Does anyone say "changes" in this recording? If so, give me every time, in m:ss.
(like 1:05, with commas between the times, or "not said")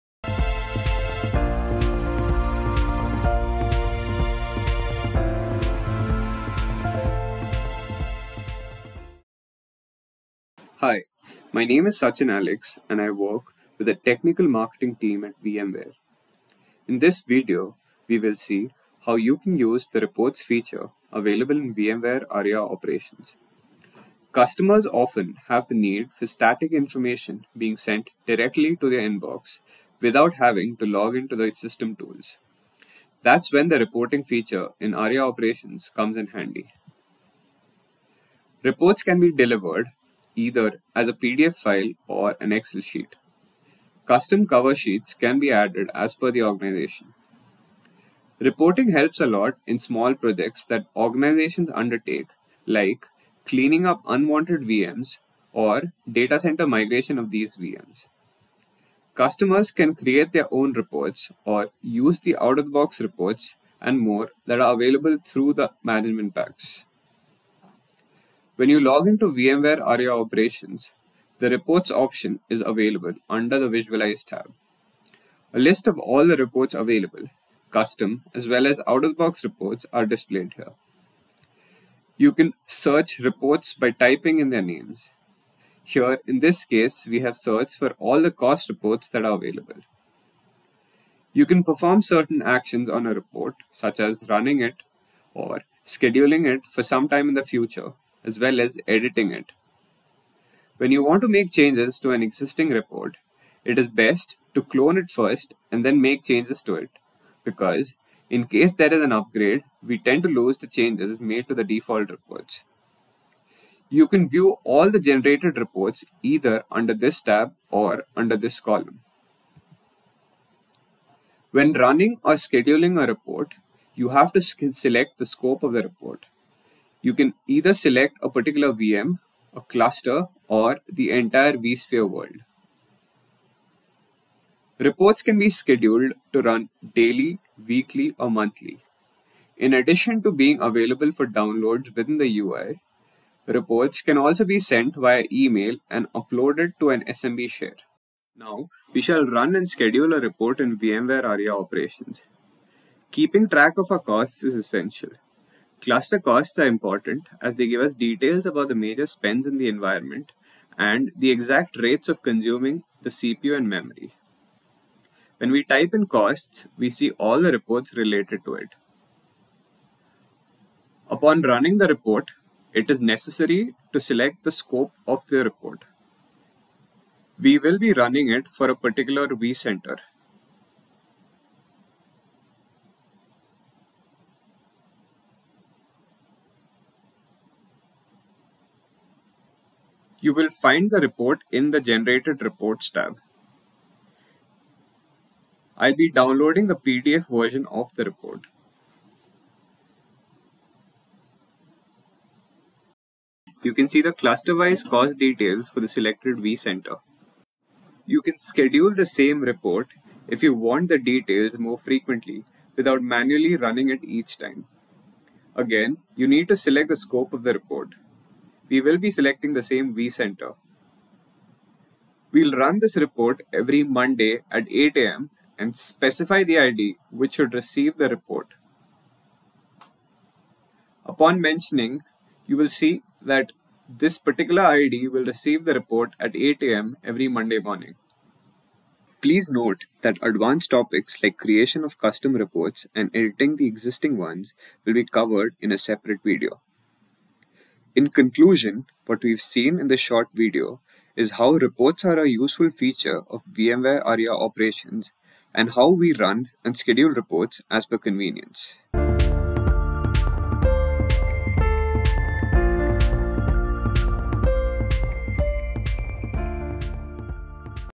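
1:41, 1:46, 1:50.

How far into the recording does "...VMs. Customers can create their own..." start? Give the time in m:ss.
0:57.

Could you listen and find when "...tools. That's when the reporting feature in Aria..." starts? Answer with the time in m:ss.
0:31.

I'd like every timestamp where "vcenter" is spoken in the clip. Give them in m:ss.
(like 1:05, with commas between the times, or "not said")
2:59, 3:26, 3:39.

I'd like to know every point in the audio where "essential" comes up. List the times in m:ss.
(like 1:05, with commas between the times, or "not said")
2:34.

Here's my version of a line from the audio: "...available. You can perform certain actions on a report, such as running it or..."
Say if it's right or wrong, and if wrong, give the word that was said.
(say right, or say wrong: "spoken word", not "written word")
right.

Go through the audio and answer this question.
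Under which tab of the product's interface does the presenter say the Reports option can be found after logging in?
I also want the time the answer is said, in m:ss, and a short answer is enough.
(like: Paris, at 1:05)
Visualize, at 1:13.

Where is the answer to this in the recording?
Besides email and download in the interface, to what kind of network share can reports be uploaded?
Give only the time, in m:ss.
2:27.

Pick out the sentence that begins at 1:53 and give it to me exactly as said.
You can view all the generated reports either under this tab or under this column.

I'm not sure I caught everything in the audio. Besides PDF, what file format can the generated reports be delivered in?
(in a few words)
Excel sheet.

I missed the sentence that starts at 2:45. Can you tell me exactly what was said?
When we type in costs, we see all the reports related to it.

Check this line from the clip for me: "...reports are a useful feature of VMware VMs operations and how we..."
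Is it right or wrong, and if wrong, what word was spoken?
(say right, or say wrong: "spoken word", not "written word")
wrong: "Aria", not "VMs".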